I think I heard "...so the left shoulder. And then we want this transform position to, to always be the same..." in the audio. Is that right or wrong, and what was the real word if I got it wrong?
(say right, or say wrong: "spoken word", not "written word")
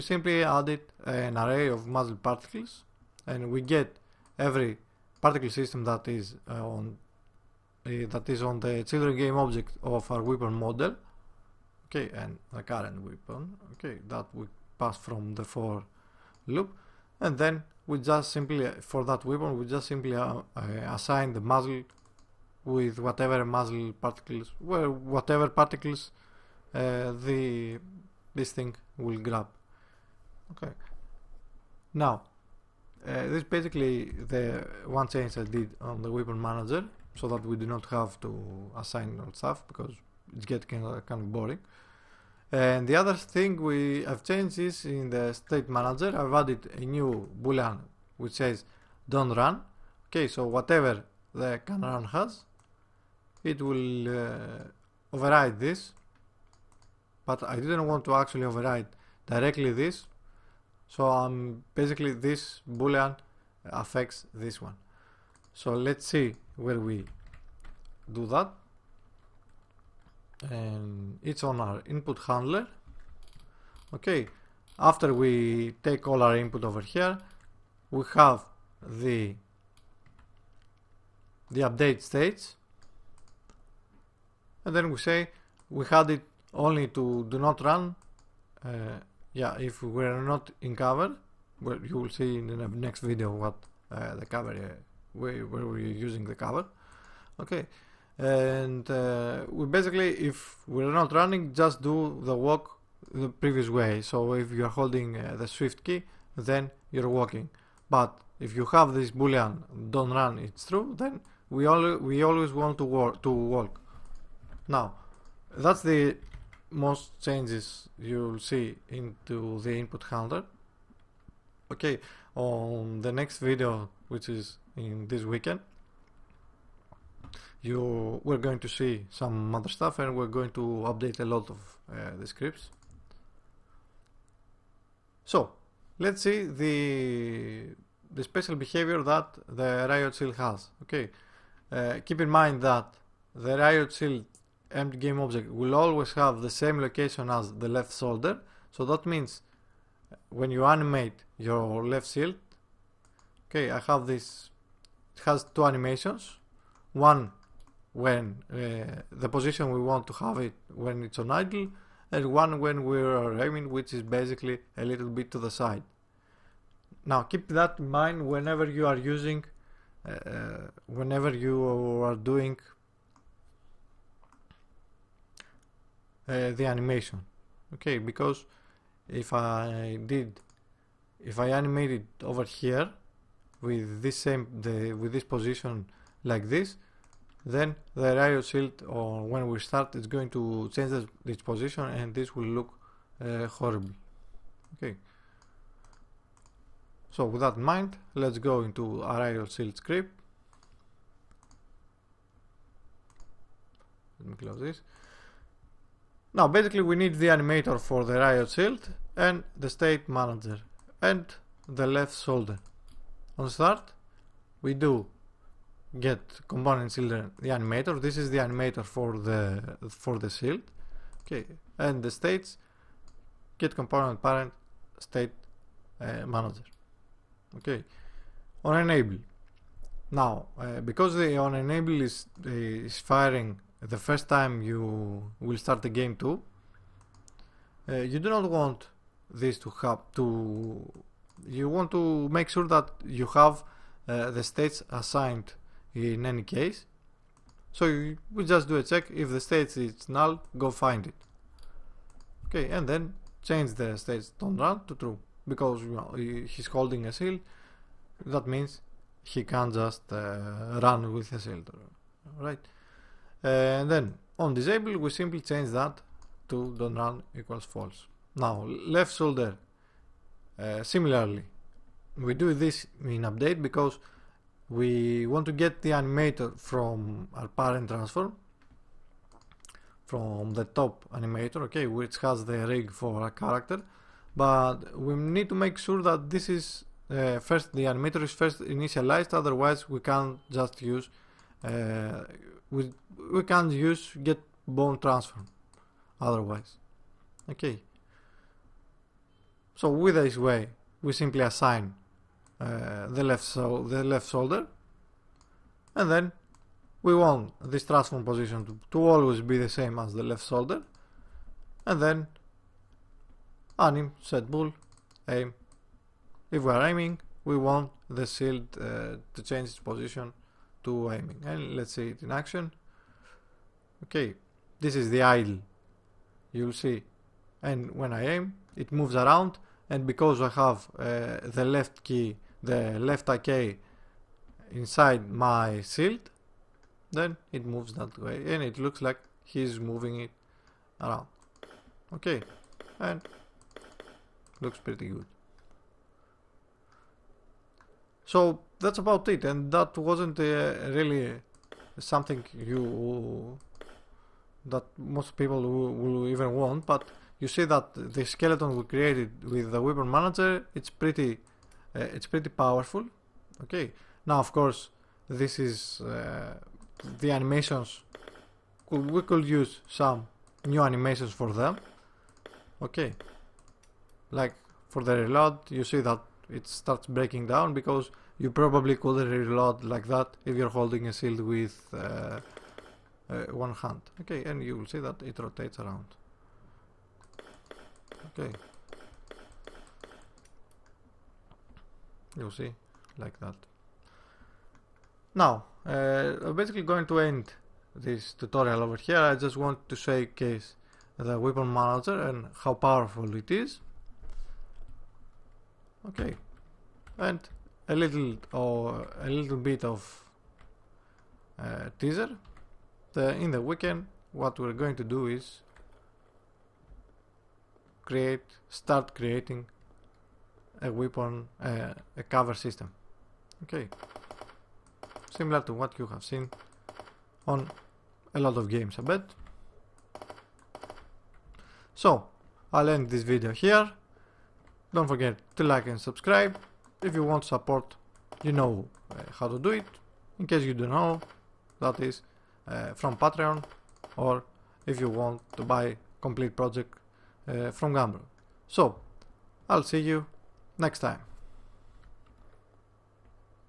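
right.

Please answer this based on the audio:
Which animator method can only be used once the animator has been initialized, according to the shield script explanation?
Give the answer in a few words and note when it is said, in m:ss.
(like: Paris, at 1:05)
get bone transform, at 4:54.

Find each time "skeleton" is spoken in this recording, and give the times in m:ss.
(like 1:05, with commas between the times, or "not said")
5:58.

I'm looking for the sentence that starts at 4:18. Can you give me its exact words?
That means he can just uh, run with a shield, right?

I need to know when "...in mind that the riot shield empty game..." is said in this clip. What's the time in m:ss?
2:22.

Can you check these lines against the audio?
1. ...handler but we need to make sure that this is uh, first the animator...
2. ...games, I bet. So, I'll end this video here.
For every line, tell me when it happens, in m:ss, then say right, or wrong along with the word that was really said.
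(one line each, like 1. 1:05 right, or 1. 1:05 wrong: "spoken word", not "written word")
1. 4:43 wrong: "character", not "handler"
2. 7:08 right.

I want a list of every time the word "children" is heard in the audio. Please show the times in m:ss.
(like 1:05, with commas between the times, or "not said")
0:08, 3:36.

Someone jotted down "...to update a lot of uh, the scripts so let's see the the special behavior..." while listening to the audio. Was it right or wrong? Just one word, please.
right.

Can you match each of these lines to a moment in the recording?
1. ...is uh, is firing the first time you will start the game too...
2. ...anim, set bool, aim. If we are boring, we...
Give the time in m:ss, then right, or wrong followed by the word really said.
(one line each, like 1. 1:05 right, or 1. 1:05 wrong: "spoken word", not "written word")
1. 3:52 right
2. 5:13 wrong: "aiming", not "boring".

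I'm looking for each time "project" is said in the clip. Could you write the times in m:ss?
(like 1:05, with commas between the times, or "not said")
7:26.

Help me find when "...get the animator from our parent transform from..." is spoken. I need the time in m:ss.
4:35.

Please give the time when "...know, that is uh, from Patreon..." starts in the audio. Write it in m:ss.
7:20.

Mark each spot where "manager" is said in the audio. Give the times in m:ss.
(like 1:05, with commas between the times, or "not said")
0:36, 0:45, 3:30, 3:46, 6:00, 6:41.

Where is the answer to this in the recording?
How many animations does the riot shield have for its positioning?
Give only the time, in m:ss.
2:35.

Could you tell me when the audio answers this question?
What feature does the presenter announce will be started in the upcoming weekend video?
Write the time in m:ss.
7:02.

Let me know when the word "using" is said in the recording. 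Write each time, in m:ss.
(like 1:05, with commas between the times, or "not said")
1:35, 2:48.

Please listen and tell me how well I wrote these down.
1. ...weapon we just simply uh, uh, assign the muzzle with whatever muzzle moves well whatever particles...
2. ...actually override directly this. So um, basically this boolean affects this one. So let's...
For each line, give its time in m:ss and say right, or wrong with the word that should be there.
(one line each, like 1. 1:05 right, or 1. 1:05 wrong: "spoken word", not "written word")
1. 0:19 wrong: "particles", not "moves"
2. 0:58 right.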